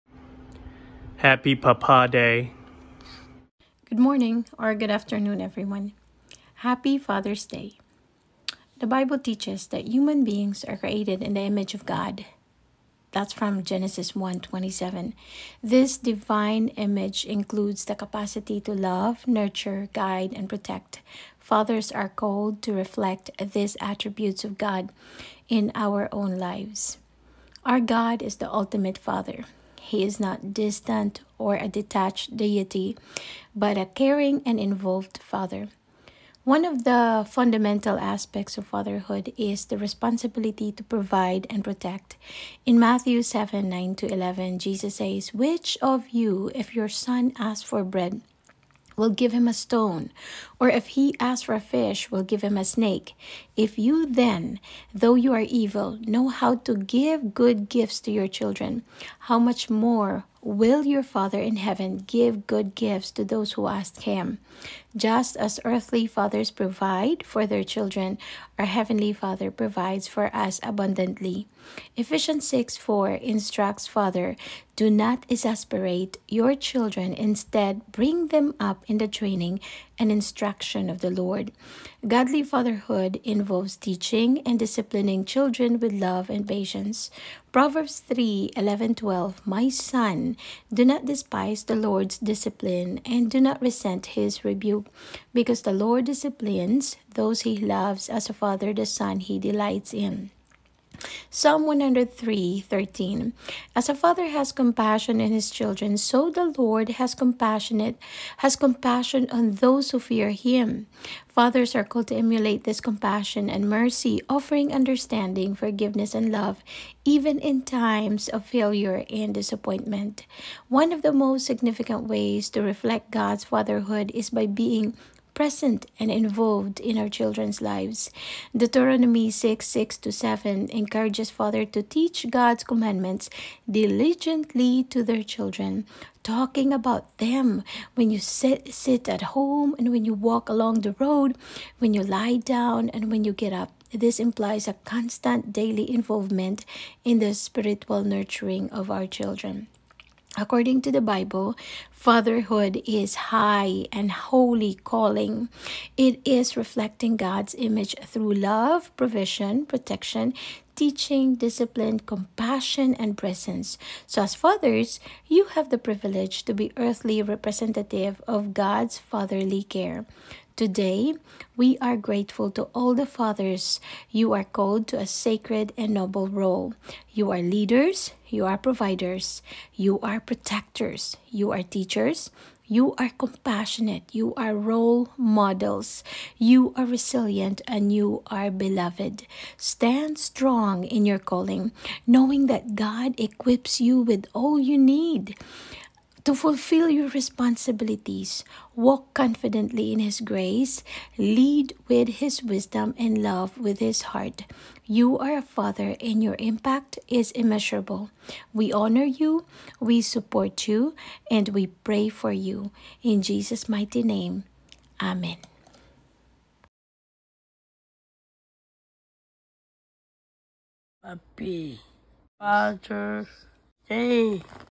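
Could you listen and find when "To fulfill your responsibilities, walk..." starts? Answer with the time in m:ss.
3:16.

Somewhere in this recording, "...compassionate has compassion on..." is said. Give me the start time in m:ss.
1:47.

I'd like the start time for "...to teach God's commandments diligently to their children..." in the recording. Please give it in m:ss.
2:11.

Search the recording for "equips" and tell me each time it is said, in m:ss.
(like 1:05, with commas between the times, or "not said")
3:13.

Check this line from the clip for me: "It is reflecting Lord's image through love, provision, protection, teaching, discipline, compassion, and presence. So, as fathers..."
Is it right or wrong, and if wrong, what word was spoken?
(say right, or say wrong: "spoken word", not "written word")
wrong: "God", not "Lord".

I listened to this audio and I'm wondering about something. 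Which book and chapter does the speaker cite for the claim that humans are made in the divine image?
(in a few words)
Genesis 27.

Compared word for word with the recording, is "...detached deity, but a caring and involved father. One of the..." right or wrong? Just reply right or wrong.
right.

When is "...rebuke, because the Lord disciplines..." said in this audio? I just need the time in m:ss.
1:34.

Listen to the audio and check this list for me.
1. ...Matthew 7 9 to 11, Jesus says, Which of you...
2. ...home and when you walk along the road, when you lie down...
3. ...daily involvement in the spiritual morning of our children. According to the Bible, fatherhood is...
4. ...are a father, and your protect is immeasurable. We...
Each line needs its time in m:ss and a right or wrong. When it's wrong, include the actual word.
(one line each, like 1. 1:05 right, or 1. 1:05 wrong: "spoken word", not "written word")
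1. 0:42 right
2. 2:19 right
3. 2:25 wrong: "nurturing", not "morning"
4. 3:25 wrong: "impact", not "protect".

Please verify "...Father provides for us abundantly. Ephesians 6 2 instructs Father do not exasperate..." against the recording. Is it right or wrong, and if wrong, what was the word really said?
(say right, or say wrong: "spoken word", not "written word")
wrong: "4", not "2".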